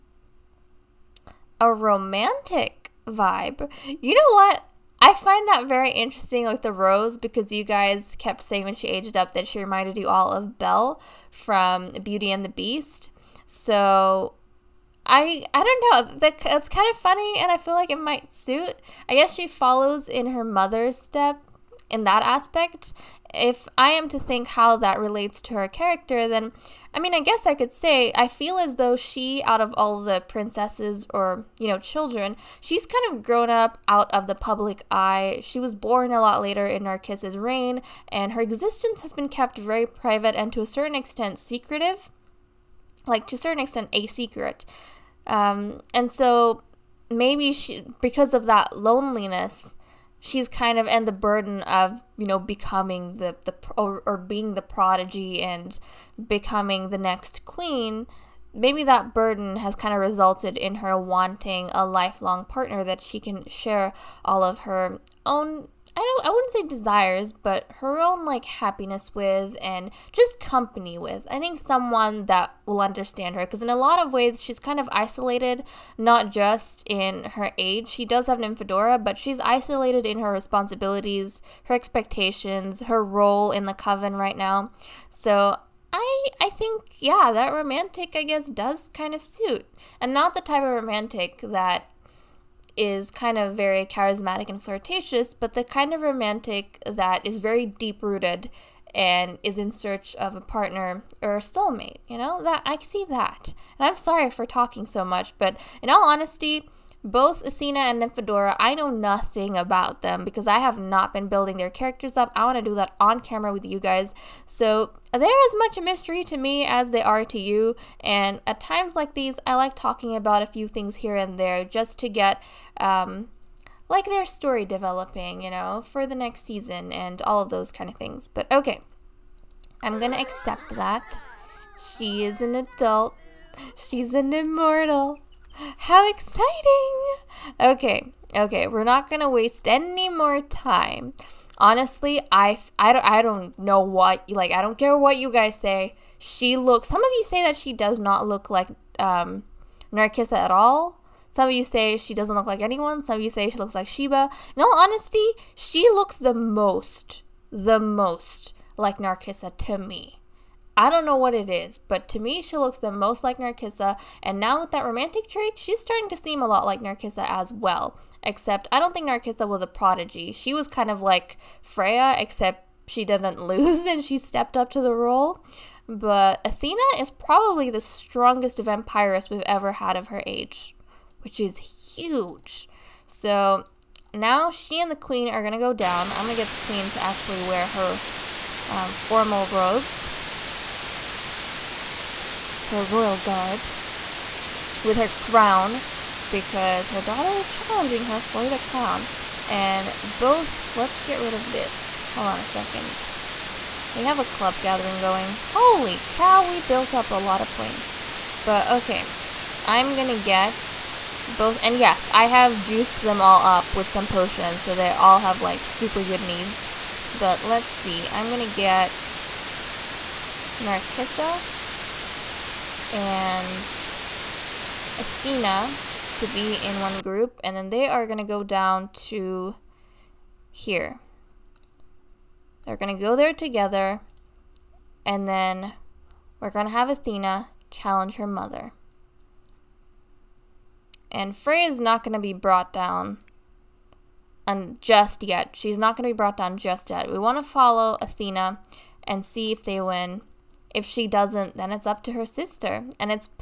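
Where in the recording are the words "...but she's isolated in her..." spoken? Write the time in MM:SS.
01:19.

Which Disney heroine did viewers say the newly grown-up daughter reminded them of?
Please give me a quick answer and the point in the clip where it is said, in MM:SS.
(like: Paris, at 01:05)
Belle, at 00:10.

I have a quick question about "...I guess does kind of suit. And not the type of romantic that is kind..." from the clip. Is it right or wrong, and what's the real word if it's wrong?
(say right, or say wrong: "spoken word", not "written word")
right.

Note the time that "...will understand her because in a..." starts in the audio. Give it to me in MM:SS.
01:12.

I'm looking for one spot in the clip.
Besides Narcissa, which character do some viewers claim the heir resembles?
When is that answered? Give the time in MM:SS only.
02:33.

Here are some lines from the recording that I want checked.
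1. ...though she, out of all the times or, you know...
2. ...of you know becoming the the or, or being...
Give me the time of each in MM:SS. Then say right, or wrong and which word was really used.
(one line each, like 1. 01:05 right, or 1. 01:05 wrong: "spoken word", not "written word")
1. 00:28 wrong: "princesses", not "times"
2. 00:51 right.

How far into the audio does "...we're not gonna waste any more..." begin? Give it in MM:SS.
02:18.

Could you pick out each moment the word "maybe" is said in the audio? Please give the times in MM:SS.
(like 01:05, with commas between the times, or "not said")
00:47, 00:58.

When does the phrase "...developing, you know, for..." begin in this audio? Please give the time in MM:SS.
02:04.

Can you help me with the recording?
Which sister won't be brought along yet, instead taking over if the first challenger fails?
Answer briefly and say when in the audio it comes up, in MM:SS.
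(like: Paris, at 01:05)
Freya, at 04:01.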